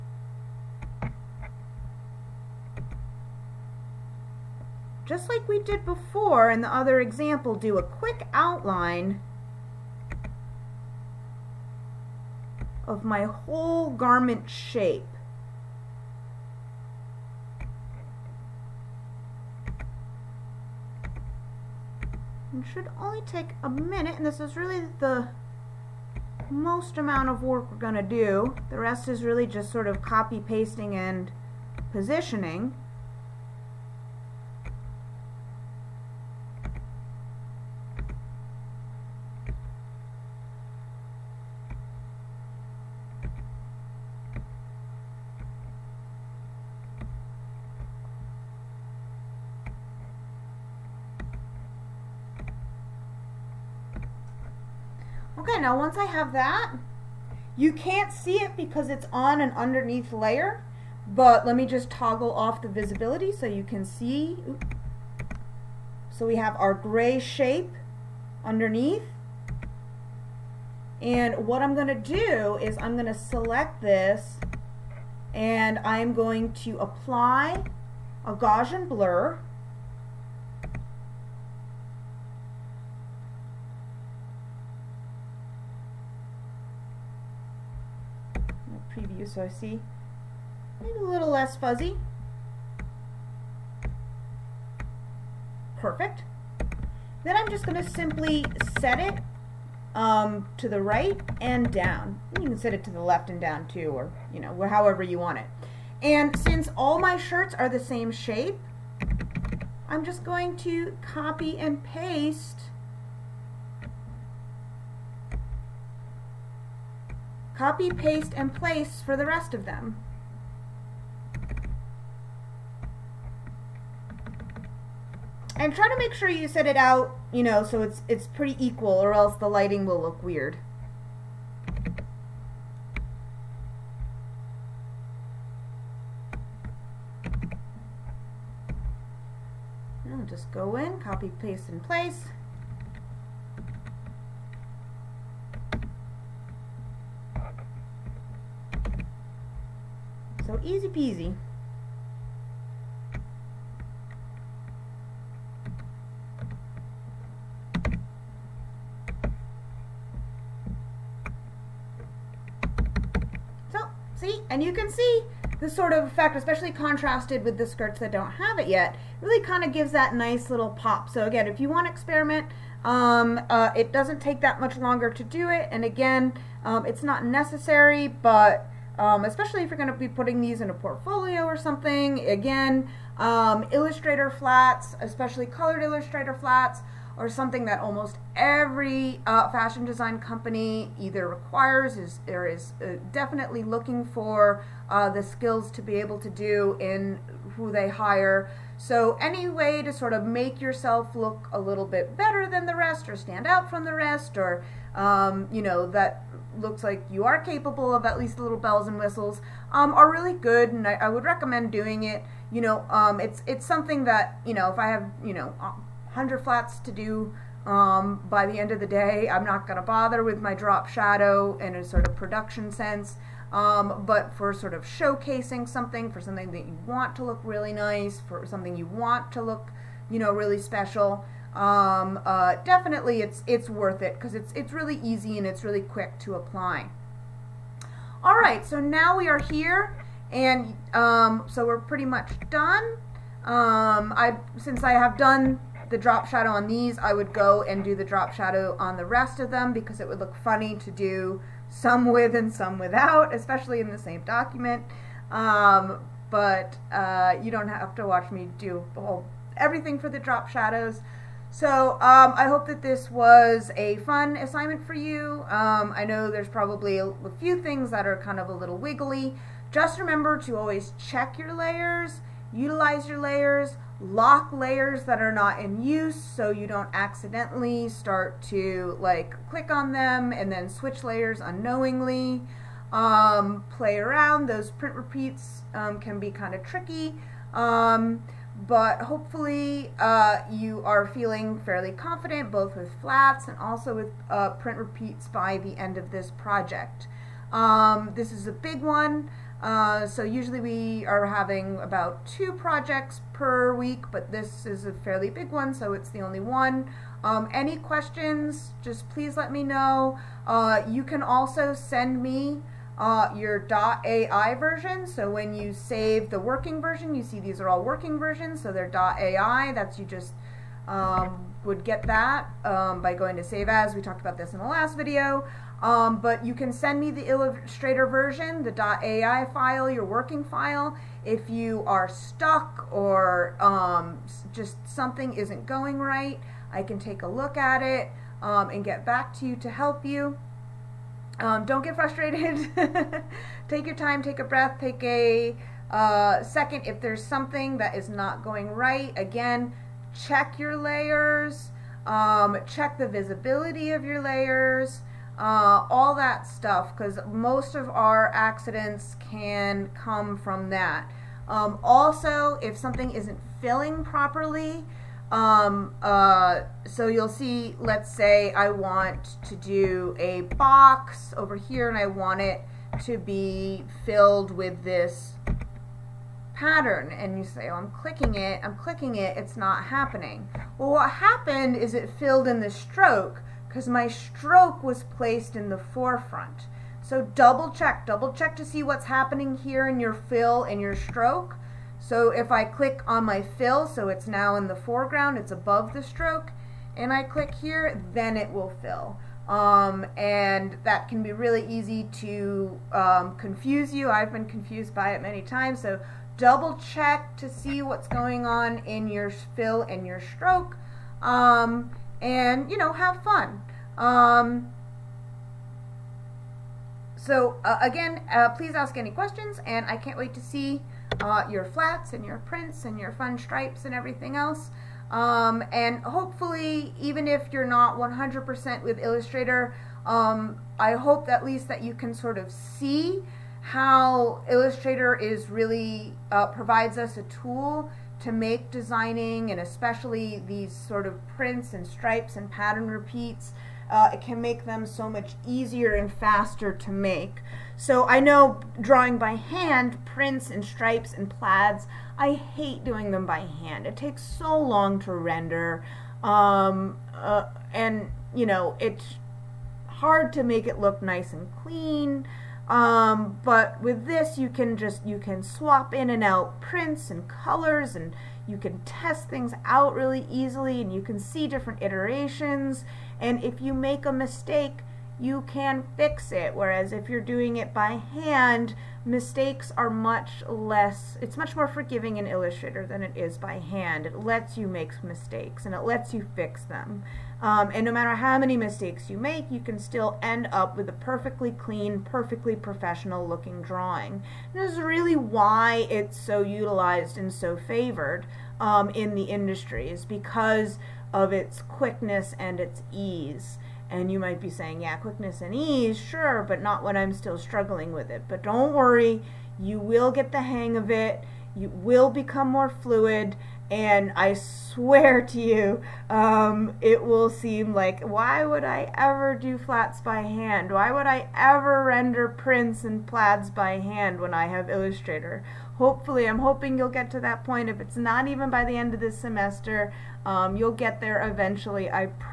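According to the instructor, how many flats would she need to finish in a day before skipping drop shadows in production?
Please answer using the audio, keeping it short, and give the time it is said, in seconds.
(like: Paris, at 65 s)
100, at 215 s.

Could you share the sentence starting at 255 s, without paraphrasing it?
Um, but uh, you don't have to watch me do whole, everything for the drop shadows.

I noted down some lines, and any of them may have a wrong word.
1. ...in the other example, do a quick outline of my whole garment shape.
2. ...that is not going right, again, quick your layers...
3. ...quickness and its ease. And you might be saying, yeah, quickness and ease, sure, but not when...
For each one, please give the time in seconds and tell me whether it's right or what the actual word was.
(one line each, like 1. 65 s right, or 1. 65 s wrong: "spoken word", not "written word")
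1. 6 s right
2. 347 s wrong: "check", not "quick"
3. 501 s right.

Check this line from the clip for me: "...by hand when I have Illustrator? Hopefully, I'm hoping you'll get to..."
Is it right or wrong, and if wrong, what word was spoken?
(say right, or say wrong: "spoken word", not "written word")
right.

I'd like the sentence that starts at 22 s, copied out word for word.
It should only take a minute, and this is really the most amount of work we're going to do.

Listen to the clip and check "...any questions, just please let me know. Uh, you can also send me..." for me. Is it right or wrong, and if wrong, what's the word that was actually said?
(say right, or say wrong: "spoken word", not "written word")
right.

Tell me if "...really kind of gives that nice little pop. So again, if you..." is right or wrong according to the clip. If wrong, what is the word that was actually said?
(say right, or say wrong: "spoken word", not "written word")
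right.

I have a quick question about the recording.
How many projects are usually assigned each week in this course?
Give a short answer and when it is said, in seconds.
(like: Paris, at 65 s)
2, at 301 s.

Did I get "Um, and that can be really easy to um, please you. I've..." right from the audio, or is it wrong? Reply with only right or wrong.
wrong.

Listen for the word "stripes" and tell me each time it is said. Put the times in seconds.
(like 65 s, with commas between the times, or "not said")
423 s, 441 s, 450 s.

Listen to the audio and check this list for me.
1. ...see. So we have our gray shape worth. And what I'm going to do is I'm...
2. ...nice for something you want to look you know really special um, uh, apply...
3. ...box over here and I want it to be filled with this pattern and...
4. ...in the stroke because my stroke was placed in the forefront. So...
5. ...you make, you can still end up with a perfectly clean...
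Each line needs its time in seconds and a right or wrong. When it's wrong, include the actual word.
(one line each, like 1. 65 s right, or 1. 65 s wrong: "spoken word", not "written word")
1. 63 s wrong: "underneath", not "worth"
2. 227 s wrong: "definitely", not "apply"
3. 370 s right
4. 382 s right
5. 489 s right.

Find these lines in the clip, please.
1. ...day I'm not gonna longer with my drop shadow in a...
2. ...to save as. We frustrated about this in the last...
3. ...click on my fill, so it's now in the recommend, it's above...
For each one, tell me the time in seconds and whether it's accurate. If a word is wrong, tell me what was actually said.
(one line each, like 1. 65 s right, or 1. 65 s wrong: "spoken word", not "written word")
1. 218 s wrong: "bother", not "longer"
2. 323 s wrong: "talked", not "frustrated"
3. 392 s wrong: "foreground", not "recommend".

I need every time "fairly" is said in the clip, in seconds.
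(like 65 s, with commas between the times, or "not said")
291 s, 304 s.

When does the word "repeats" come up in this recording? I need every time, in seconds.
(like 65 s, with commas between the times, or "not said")
284 s, 294 s, 442 s.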